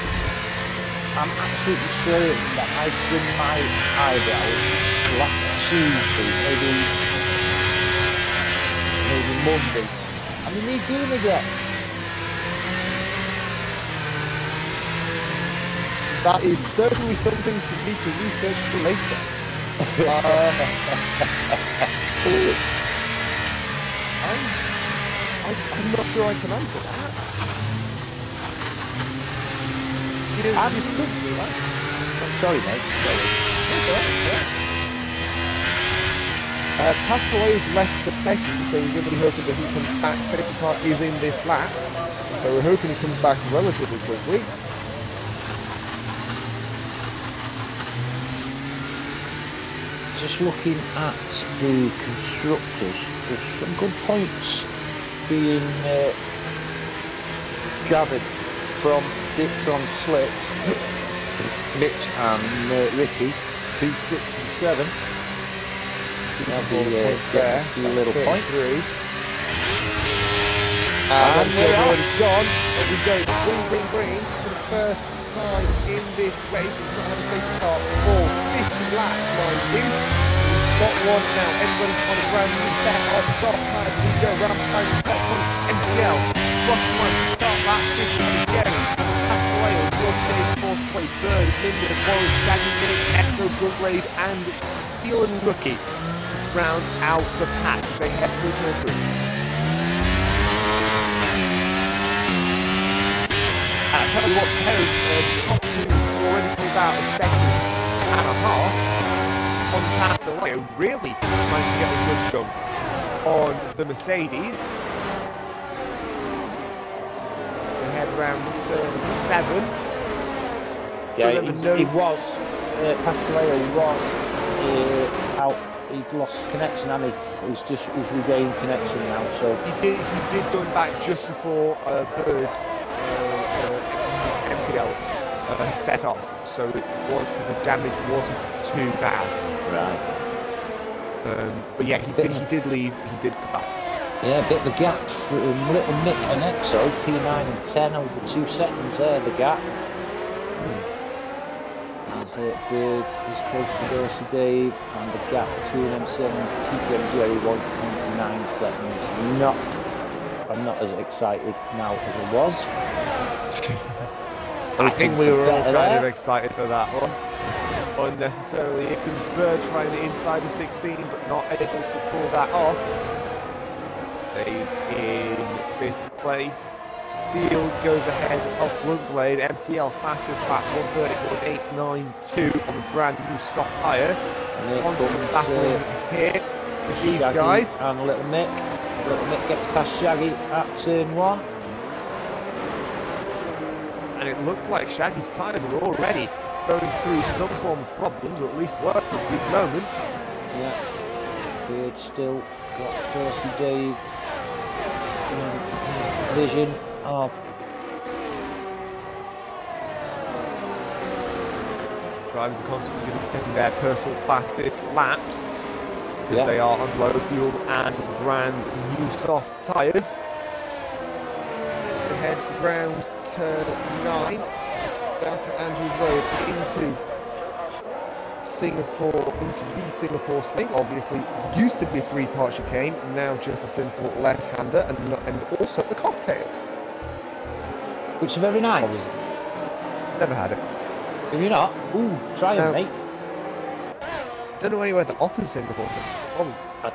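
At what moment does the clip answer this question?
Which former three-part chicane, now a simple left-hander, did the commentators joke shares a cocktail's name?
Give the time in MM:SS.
03:49.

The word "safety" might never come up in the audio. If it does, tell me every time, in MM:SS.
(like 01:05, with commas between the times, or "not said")
00:40, 01:17.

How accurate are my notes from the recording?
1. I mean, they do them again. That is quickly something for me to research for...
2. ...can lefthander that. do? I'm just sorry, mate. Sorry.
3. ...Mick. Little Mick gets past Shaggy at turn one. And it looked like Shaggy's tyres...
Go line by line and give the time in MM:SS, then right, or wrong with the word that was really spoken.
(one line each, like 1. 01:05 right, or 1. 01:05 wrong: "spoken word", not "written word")
1. 00:09 wrong: "certainly", not "quickly"
2. 00:26 wrong: "answer", not "lefthander"
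3. 03:08 right.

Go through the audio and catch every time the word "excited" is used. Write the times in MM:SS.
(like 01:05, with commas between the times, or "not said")
02:40, 02:46.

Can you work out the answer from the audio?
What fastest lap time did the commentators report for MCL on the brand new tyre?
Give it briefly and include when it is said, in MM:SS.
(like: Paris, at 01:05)
134.892, at 03:01.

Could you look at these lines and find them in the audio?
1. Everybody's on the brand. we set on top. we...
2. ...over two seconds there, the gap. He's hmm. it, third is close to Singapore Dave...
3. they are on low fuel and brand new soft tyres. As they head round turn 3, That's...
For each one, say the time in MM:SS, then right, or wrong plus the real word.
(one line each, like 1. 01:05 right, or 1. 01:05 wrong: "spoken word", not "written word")
1. 01:21 wrong: "ground", not "brand"
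2. 02:27 wrong: "Dorsey", not "Singapore"
3. 03:36 wrong: "9", not "3".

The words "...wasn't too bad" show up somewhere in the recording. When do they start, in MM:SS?
02:18.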